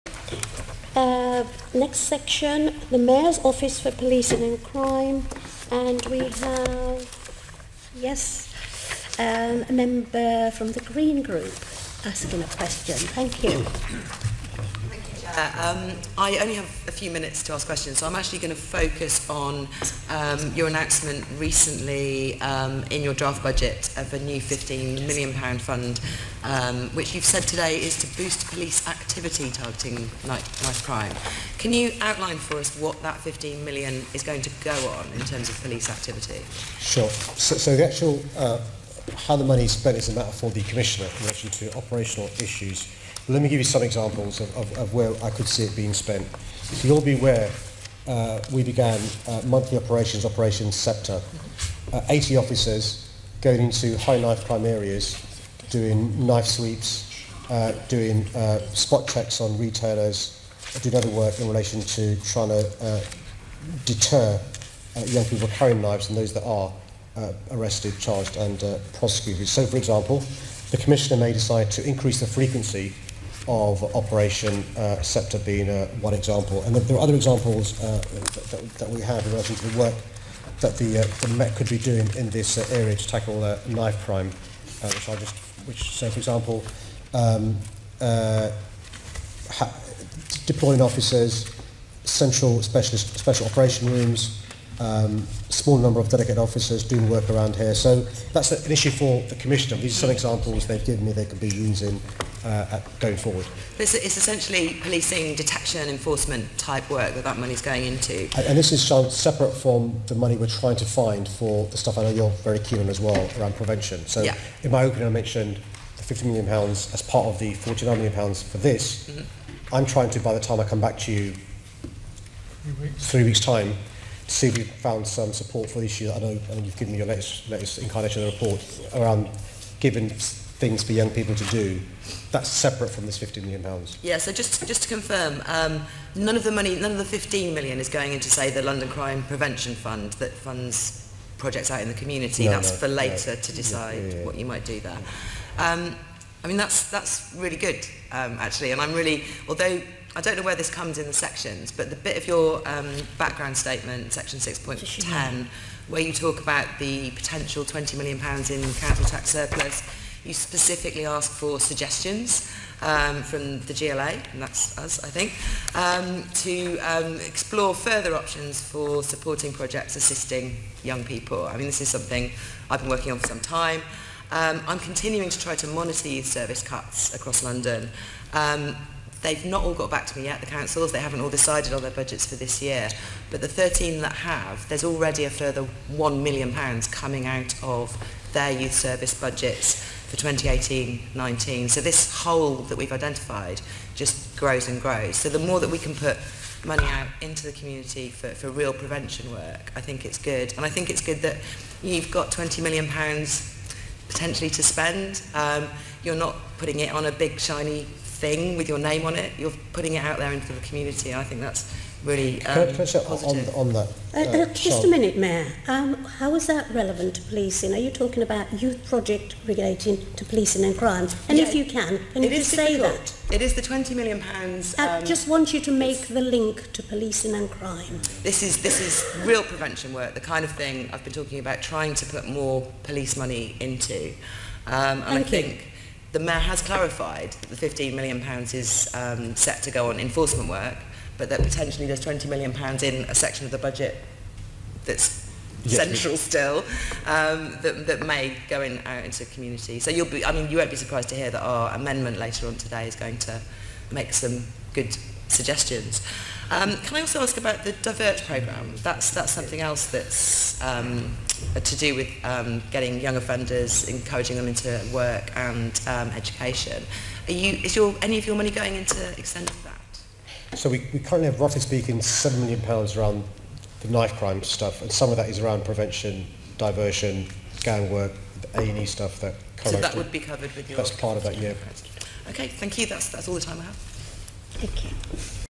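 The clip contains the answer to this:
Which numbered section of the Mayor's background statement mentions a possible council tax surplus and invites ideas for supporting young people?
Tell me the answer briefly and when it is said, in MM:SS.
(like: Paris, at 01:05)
6.10, at 02:34.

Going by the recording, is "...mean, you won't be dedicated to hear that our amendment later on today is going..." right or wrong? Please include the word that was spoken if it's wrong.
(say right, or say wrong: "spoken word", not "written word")
wrong: "surprised", not "dedicated".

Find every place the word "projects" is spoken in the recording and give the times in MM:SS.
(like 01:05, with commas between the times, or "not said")
02:21, 02:49, 03:38.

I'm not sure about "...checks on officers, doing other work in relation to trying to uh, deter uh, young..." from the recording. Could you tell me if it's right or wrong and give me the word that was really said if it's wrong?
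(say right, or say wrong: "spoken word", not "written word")
wrong: "retailers", not "officers".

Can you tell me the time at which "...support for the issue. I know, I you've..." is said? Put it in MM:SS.
02:05.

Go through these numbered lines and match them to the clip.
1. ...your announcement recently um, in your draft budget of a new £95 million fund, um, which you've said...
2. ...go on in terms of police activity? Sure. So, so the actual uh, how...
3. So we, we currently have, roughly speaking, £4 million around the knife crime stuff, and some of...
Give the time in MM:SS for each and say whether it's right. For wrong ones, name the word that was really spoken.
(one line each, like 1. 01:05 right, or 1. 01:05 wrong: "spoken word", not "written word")
1. 00:20 wrong: "15", not "95"
2. 00:34 right
3. 04:30 wrong: "7", not "4".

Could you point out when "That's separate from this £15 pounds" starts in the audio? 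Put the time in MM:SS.
02:12.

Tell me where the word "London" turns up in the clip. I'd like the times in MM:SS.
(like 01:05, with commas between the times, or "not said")
02:18, 02:57.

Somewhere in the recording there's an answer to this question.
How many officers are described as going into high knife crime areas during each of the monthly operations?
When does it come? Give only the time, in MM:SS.
00:52.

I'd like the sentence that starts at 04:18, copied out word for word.
That's, that's something else that's um, to do with um, getting young offenders, encouraging them into work and um, education.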